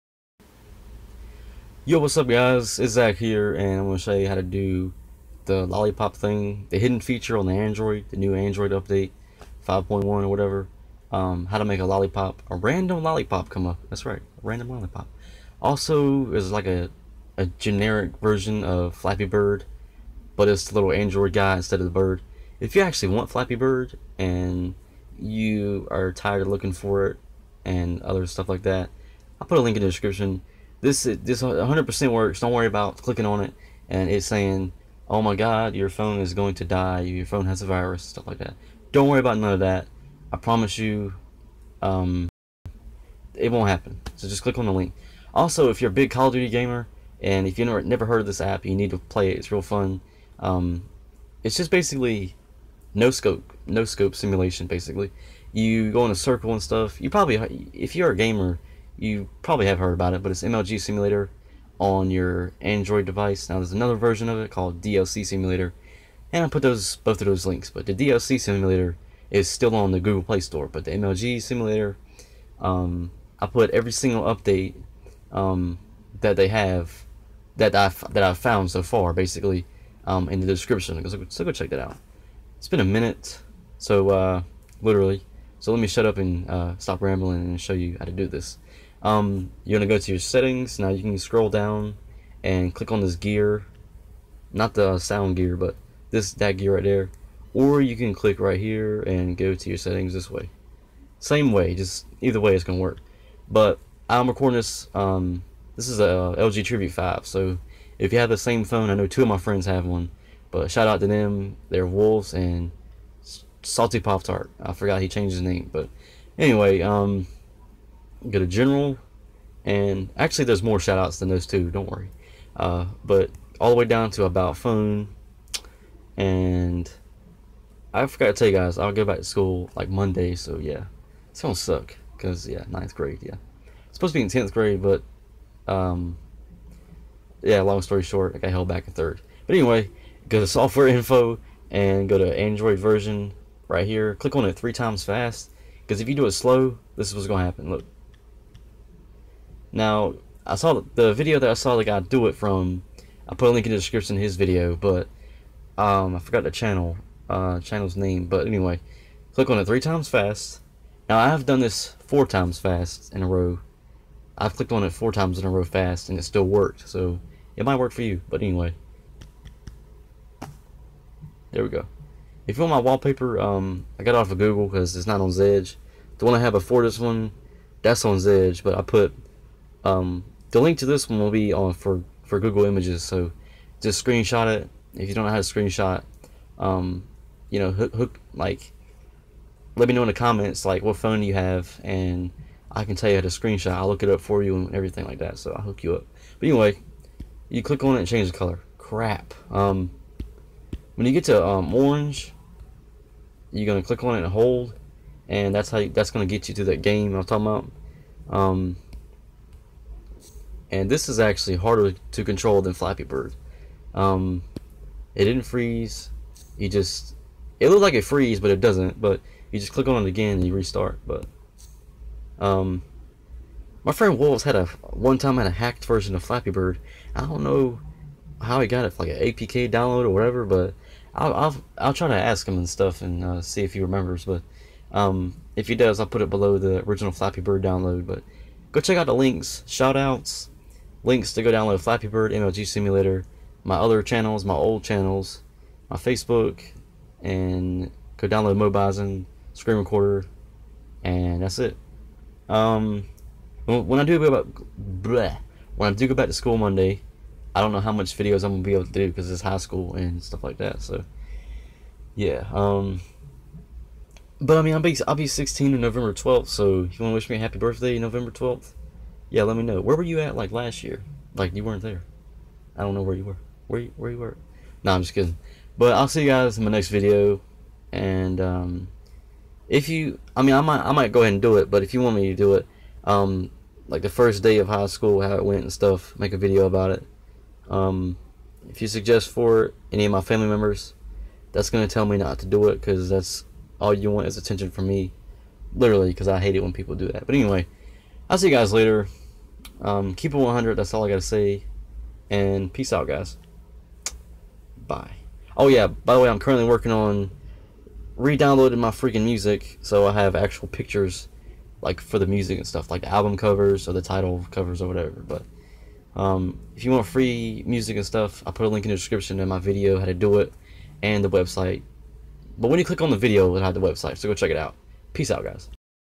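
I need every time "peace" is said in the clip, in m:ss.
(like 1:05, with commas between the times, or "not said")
5:02, 5:25.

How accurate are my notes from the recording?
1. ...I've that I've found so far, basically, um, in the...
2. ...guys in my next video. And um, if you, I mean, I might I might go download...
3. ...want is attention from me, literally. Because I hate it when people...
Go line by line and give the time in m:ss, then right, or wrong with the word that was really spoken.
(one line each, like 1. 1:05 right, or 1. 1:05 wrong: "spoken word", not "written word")
1. 1:17 right
2. 4:36 wrong: "ahead", not "download"
3. 4:54 right.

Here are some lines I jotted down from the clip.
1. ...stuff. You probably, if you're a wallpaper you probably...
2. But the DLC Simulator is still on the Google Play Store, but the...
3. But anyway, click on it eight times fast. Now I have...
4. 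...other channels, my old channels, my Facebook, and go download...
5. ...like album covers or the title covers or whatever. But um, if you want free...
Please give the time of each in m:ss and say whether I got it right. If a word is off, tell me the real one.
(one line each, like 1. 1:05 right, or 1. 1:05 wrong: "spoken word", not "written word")
1. 0:56 wrong: "gamer", not "wallpaper"
2. 1:07 right
3. 2:38 wrong: "three", not "eight"
4. 4:03 right
5. 5:12 right.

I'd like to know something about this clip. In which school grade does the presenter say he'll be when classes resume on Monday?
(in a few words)
ninth grade.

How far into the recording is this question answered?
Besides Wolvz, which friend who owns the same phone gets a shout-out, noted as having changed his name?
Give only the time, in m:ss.
1:53.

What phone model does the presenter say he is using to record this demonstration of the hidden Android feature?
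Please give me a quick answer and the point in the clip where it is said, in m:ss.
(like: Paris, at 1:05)
LG Tribute 5, at 1:46.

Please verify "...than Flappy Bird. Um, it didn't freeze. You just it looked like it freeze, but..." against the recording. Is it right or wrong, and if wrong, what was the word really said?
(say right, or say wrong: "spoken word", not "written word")
right.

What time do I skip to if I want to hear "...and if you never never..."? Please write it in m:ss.
0:47.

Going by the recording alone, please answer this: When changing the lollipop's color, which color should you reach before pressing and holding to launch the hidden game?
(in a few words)
orange.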